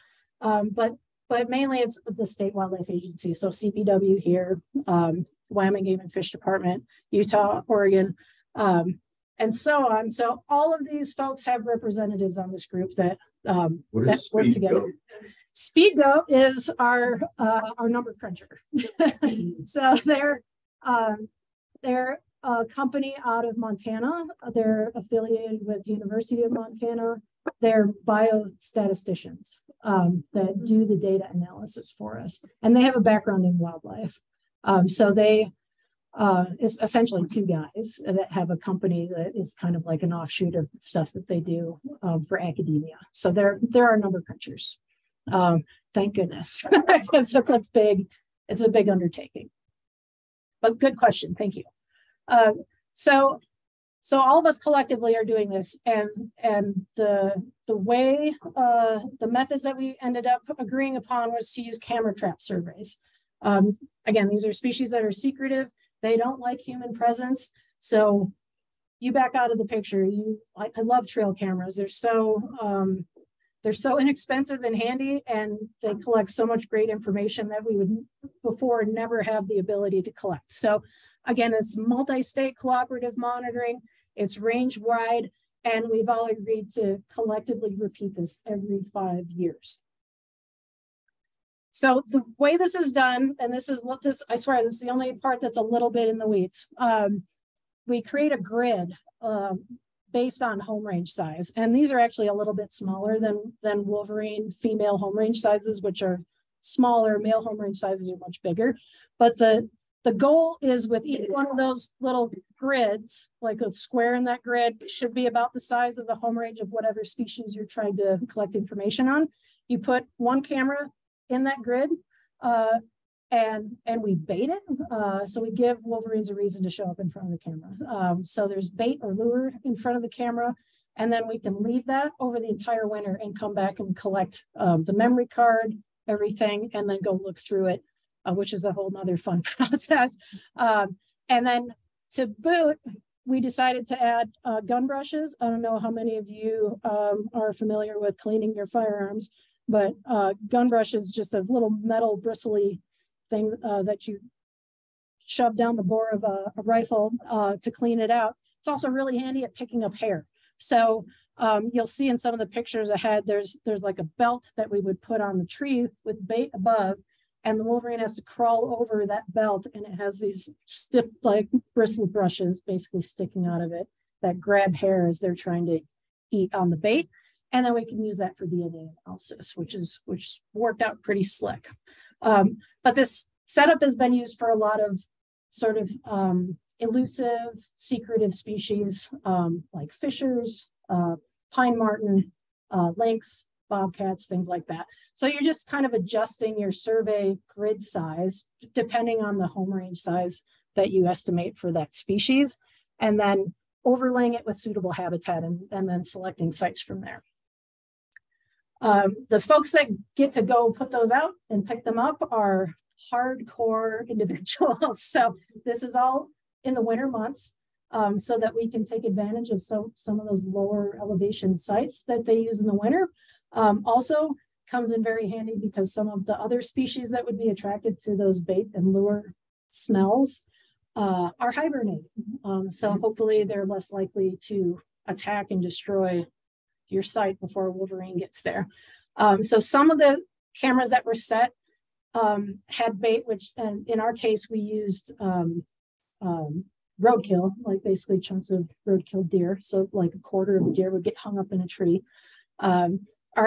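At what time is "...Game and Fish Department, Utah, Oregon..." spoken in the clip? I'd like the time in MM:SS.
00:05.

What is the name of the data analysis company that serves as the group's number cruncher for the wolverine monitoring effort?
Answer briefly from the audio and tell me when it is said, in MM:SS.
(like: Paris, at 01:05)
Speed Goat, at 00:15.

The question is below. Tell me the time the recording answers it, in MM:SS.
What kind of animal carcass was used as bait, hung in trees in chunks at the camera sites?
04:08.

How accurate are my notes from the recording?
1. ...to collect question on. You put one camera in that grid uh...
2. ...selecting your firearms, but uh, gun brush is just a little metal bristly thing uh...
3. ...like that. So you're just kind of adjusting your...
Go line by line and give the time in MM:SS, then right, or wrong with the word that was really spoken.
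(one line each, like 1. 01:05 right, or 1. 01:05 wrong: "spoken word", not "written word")
1. 01:57 wrong: "information", not "question"
2. 02:28 wrong: "cleaning", not "selecting"
3. 03:14 right.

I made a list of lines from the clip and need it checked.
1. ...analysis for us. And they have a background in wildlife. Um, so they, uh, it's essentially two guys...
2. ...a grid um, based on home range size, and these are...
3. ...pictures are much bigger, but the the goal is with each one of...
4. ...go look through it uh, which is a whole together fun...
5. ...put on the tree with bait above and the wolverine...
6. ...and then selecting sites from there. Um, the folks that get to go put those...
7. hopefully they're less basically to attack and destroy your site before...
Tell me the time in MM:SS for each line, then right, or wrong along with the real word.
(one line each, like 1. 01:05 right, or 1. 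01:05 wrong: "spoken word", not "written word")
1. 00:31 right
2. 01:38 right
3. 01:47 wrong: "sizes", not "pictures"
4. 02:17 wrong: "nother", not "together"
5. 02:45 right
6. 03:25 right
7. 03:52 wrong: "likely", not "basically".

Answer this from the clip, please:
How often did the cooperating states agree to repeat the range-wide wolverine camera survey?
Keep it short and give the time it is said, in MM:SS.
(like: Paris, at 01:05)
Every 5 years, at 01:28.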